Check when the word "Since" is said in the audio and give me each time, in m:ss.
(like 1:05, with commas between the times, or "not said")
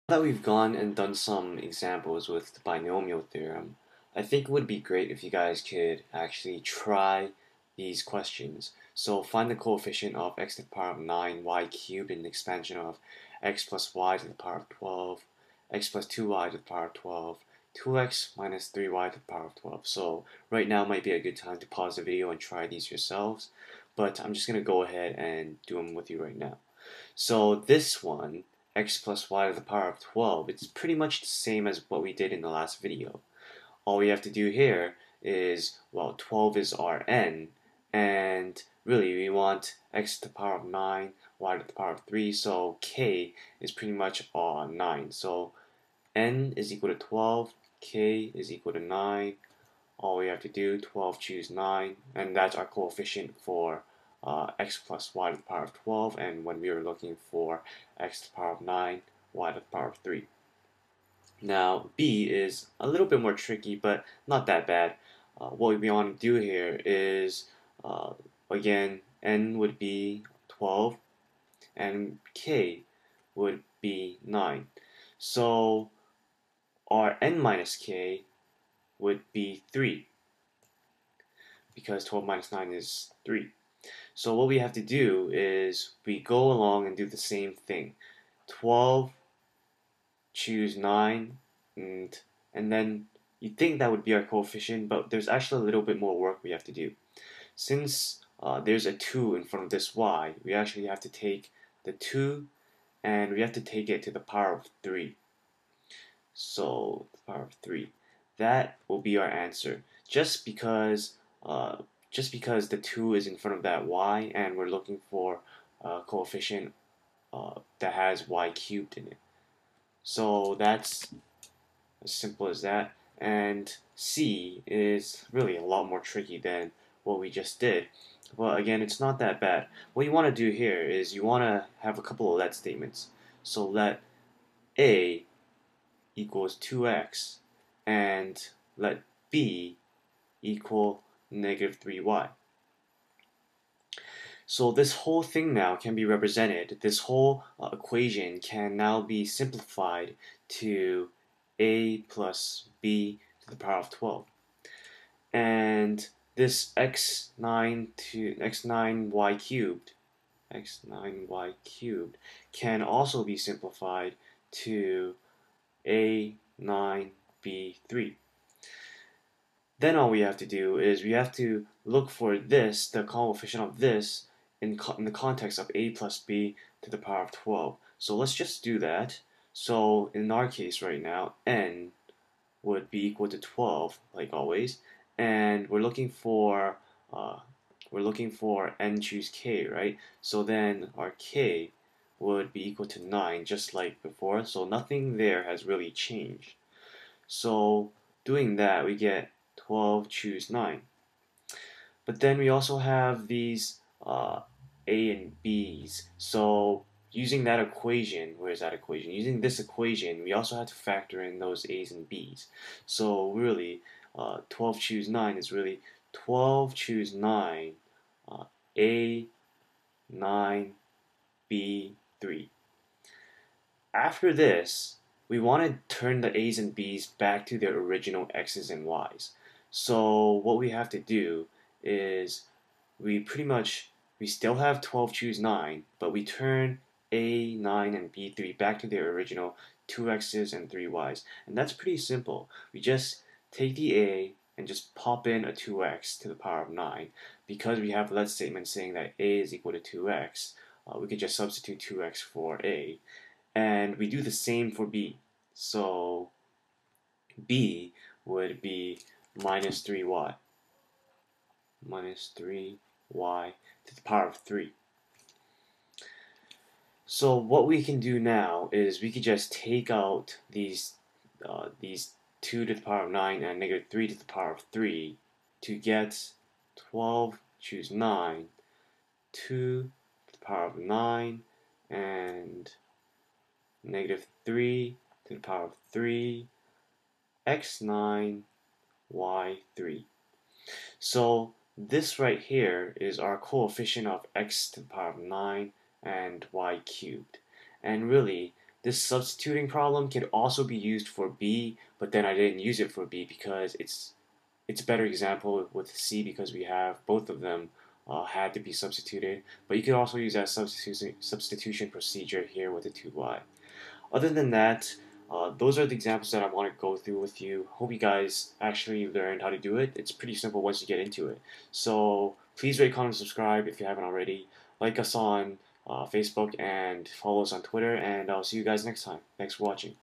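1:37.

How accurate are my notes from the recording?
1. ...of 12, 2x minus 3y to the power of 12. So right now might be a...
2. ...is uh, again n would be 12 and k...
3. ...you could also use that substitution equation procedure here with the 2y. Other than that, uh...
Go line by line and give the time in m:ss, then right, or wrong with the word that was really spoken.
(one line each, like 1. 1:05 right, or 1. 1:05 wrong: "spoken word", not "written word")
1. 0:16 right
2. 1:06 right
3. 5:09 wrong: "substitution", not "equation".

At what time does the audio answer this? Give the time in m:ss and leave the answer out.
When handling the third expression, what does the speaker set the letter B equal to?
2:21.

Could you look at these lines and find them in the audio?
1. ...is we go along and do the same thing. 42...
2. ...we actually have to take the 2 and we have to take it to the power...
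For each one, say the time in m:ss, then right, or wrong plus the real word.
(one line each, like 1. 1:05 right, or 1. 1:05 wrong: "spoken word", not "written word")
1. 1:25 wrong: "12", not "42"
2. 1:40 right.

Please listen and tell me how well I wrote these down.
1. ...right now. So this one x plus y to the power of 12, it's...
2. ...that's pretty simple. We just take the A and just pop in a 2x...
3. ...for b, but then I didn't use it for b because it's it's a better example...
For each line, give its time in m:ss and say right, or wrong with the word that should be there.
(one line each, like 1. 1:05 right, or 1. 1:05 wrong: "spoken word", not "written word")
1. 0:26 right
2. 4:01 right
3. 5:01 right.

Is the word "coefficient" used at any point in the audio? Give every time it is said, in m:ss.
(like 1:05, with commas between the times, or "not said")
0:09, 0:52, 1:34, 1:56, 2:53, 4:53.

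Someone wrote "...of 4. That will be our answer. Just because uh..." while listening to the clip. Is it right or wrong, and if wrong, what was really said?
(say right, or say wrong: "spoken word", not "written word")
wrong: "3", not "4".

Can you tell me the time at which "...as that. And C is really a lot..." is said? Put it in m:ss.
2:02.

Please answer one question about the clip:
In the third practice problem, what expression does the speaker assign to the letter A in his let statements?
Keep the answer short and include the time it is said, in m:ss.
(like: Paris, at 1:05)
2x, at 2:13.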